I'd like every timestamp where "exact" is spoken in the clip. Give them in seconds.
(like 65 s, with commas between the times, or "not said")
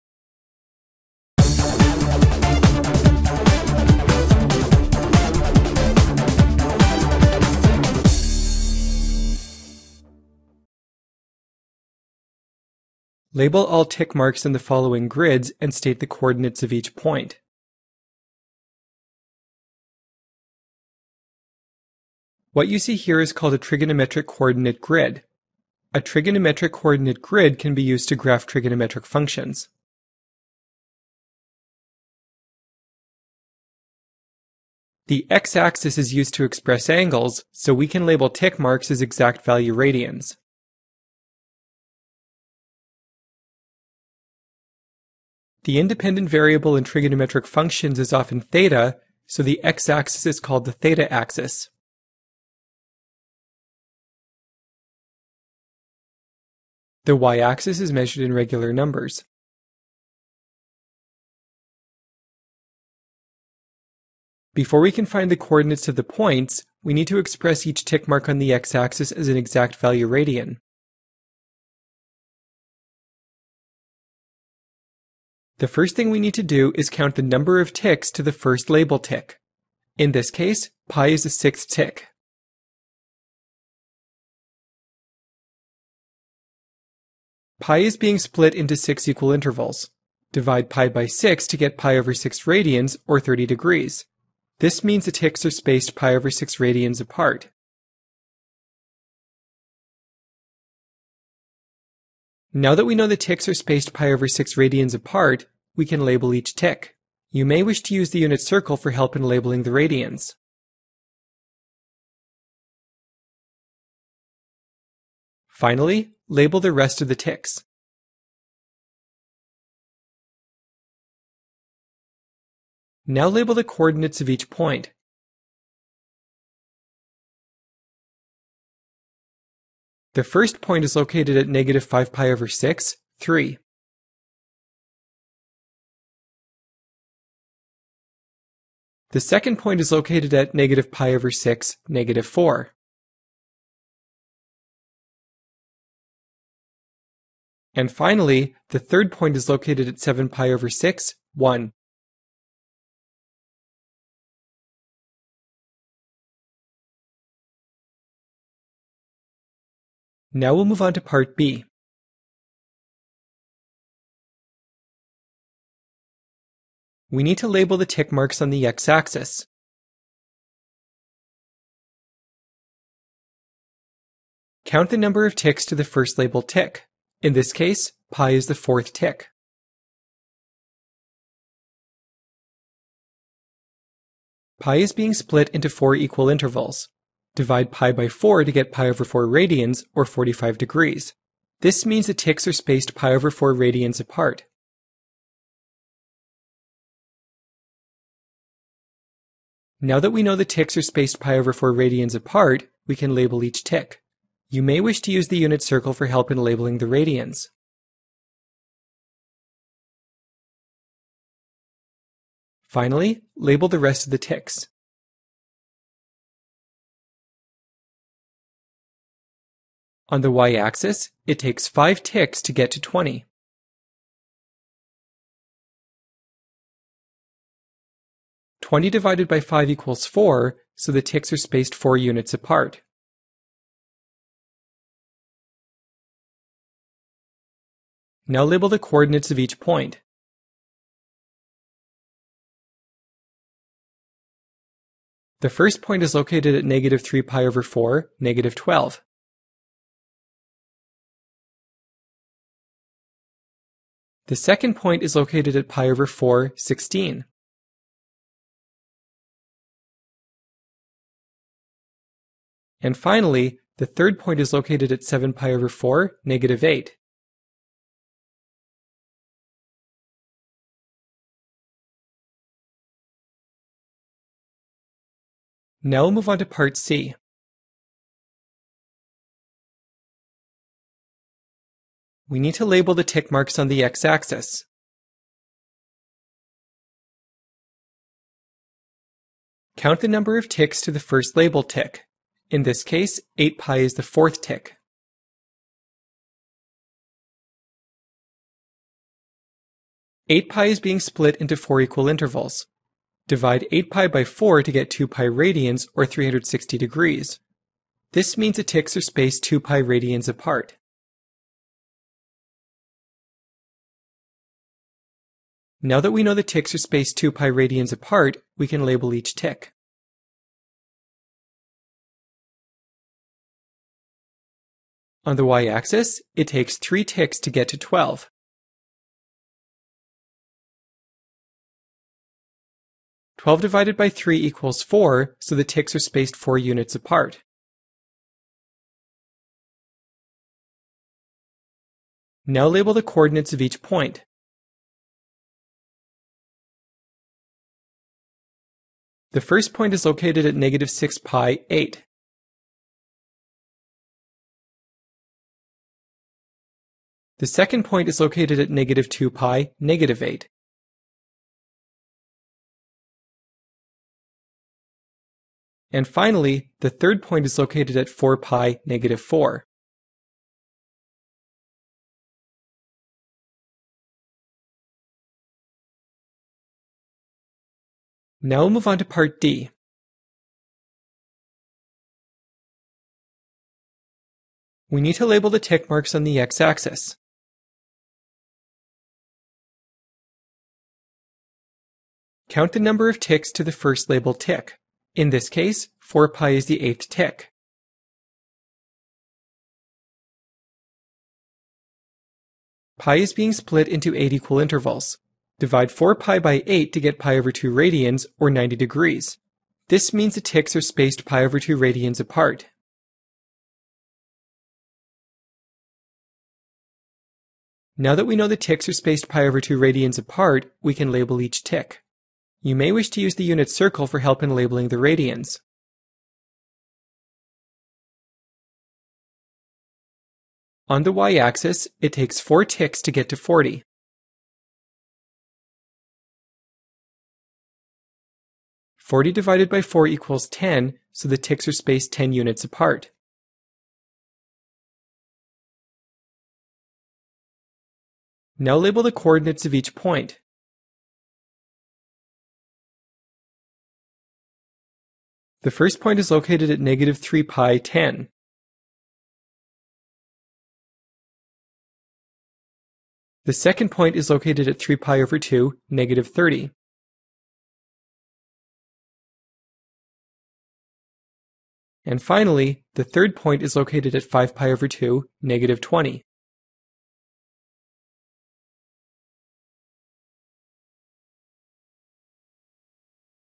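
39 s, 69 s.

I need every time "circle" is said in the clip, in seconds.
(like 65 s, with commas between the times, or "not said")
108 s, 205 s, 423 s.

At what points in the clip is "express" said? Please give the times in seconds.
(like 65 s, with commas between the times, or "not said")
36 s, 67 s.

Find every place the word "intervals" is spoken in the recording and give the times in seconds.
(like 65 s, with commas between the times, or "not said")
89 s, 186 s, 302 s, 404 s.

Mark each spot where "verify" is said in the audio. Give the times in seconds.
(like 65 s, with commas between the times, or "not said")
not said.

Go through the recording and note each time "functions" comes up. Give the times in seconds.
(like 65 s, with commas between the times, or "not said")
29 s, 47 s.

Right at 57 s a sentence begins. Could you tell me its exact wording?
The y-axis is measured in regular numbers.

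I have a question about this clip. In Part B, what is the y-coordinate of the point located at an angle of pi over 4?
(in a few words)
16.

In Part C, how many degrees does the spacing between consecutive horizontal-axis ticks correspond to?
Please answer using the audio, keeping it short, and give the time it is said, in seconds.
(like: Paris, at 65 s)
360 degrees, at 306 s.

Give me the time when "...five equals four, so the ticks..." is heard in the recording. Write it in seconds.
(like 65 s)
229 s.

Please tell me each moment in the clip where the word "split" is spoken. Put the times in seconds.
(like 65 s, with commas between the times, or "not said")
88 s, 185 s, 301 s, 403 s.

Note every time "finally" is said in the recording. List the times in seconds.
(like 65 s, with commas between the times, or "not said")
115 s, 147 s, 212 s, 262 s, 366 s, 472 s.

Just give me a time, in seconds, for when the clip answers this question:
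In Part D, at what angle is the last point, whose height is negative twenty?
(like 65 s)
474 s.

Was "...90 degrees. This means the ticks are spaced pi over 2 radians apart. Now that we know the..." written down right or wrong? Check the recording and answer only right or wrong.
right.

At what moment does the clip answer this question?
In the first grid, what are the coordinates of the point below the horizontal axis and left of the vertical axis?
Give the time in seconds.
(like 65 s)
140 s.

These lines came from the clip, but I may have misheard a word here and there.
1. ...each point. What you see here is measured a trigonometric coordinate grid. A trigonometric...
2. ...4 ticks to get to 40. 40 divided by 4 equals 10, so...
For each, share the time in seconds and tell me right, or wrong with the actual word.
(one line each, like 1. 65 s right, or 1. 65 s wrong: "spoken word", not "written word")
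1. 16 s wrong: "called", not "measured"
2. 432 s right.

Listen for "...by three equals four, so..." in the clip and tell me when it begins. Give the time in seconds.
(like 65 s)
333 s.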